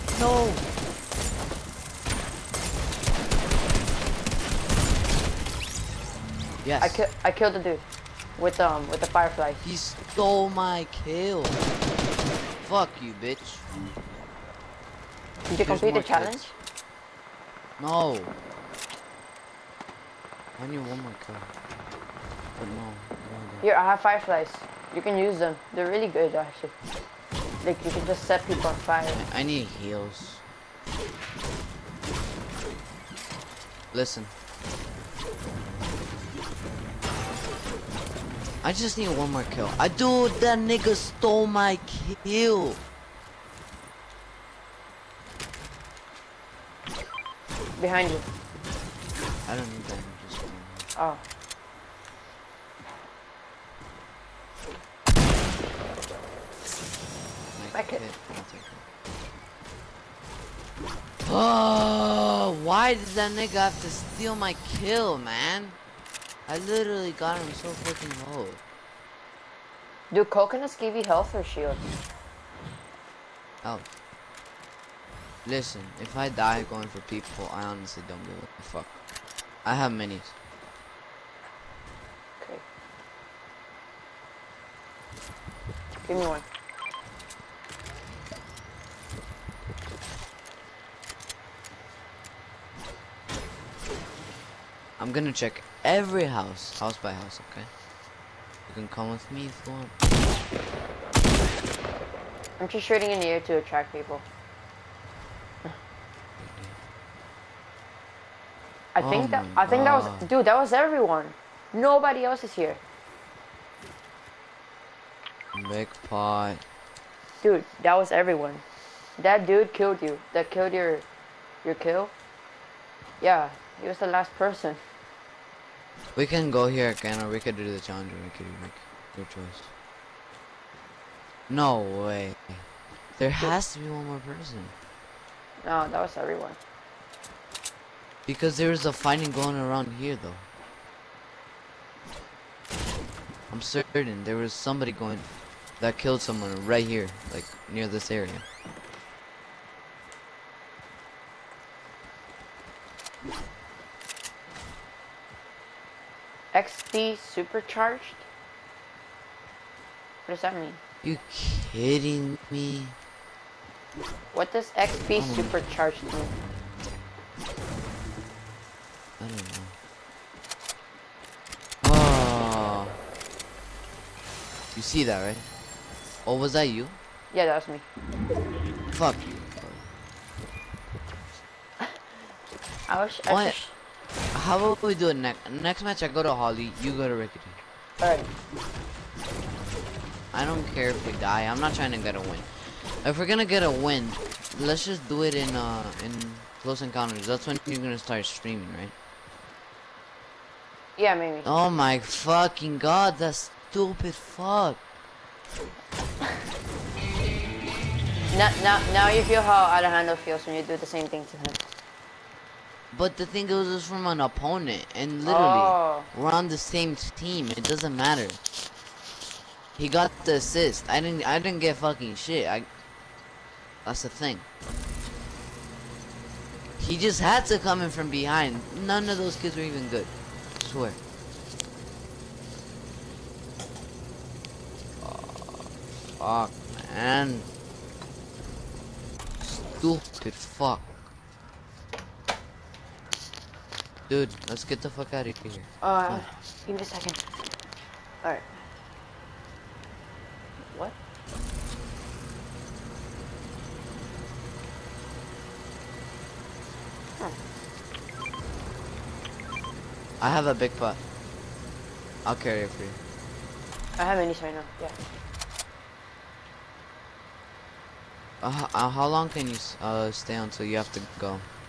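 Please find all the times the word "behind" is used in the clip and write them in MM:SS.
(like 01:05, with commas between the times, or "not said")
00:47, 03:48.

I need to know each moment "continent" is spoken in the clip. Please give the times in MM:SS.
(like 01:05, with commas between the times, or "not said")
not said.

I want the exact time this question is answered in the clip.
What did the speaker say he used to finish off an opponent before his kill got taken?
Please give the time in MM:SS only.
00:08.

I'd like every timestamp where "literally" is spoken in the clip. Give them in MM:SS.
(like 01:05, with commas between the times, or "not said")
01:06, 03:35.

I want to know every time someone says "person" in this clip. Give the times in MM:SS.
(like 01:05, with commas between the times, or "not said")
02:04, 02:14.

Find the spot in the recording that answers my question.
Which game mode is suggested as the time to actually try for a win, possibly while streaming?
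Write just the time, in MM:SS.
03:16.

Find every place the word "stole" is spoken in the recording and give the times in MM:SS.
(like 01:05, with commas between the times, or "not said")
00:09, 00:40.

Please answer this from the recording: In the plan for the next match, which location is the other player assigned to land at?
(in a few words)
Rickety.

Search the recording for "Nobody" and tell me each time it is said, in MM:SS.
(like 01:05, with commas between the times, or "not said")
01:51.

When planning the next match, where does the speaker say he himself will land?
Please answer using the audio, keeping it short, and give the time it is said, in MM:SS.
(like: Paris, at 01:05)
Holly, at 03:06.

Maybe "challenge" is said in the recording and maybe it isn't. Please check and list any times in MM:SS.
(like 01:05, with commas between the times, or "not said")
00:16, 02:07.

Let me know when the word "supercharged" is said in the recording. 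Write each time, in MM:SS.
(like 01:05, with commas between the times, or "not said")
02:37, 02:45.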